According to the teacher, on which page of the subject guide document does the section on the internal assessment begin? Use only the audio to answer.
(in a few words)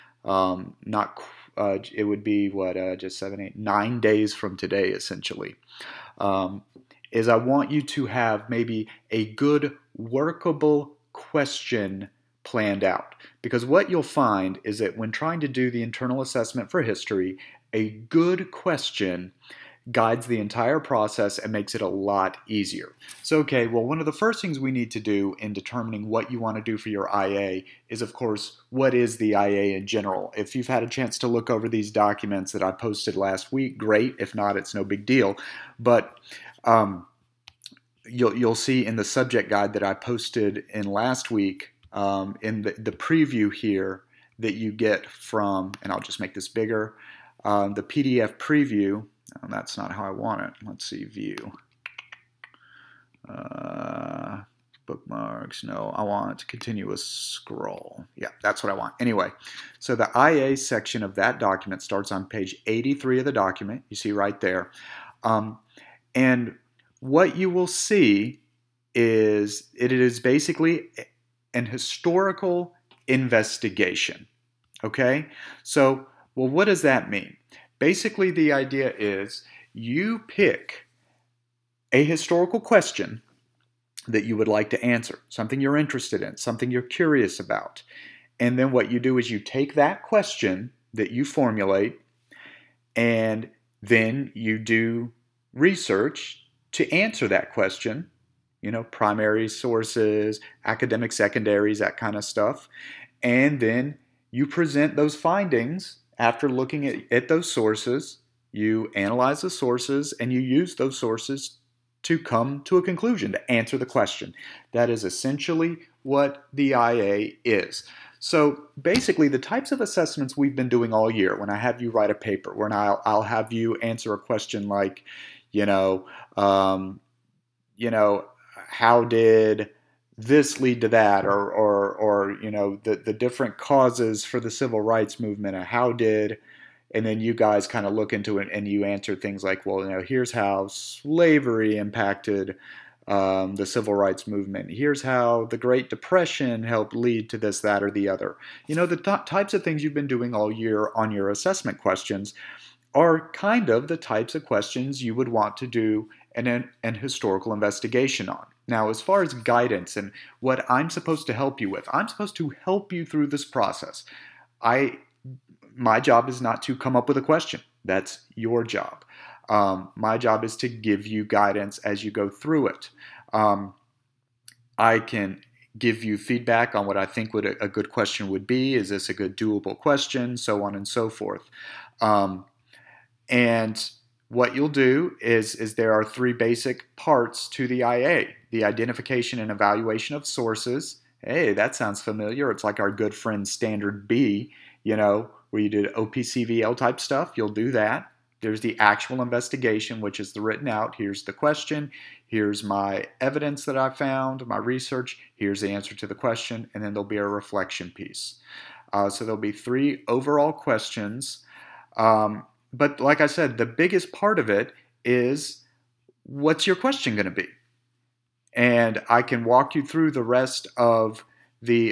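83.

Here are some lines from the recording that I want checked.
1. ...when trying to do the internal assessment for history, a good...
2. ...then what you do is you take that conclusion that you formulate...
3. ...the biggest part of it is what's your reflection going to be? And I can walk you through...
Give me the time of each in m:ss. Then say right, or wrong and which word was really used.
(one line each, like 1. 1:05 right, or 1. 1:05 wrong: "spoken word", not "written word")
1. 0:14 right
2. 1:28 wrong: "question", not "conclusion"
3. 3:33 wrong: "question", not "reflection".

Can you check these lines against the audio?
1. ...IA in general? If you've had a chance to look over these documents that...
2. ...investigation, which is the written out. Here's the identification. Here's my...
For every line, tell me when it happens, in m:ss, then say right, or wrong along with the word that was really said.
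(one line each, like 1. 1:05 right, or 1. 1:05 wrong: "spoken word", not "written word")
1. 0:29 right
2. 3:19 wrong: "question", not "identification".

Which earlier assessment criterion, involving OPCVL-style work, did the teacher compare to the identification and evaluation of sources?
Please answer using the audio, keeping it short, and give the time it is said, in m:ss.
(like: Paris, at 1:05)
standard B, at 3:13.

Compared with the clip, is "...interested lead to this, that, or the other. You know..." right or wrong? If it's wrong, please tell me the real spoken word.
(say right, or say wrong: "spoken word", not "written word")
wrong: "helped", not "interested".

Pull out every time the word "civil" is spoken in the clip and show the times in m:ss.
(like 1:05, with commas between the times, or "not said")
2:14, 2:23.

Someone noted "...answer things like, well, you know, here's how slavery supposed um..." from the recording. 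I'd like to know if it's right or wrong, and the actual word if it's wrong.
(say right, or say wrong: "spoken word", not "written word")
wrong: "impacted", not "supposed".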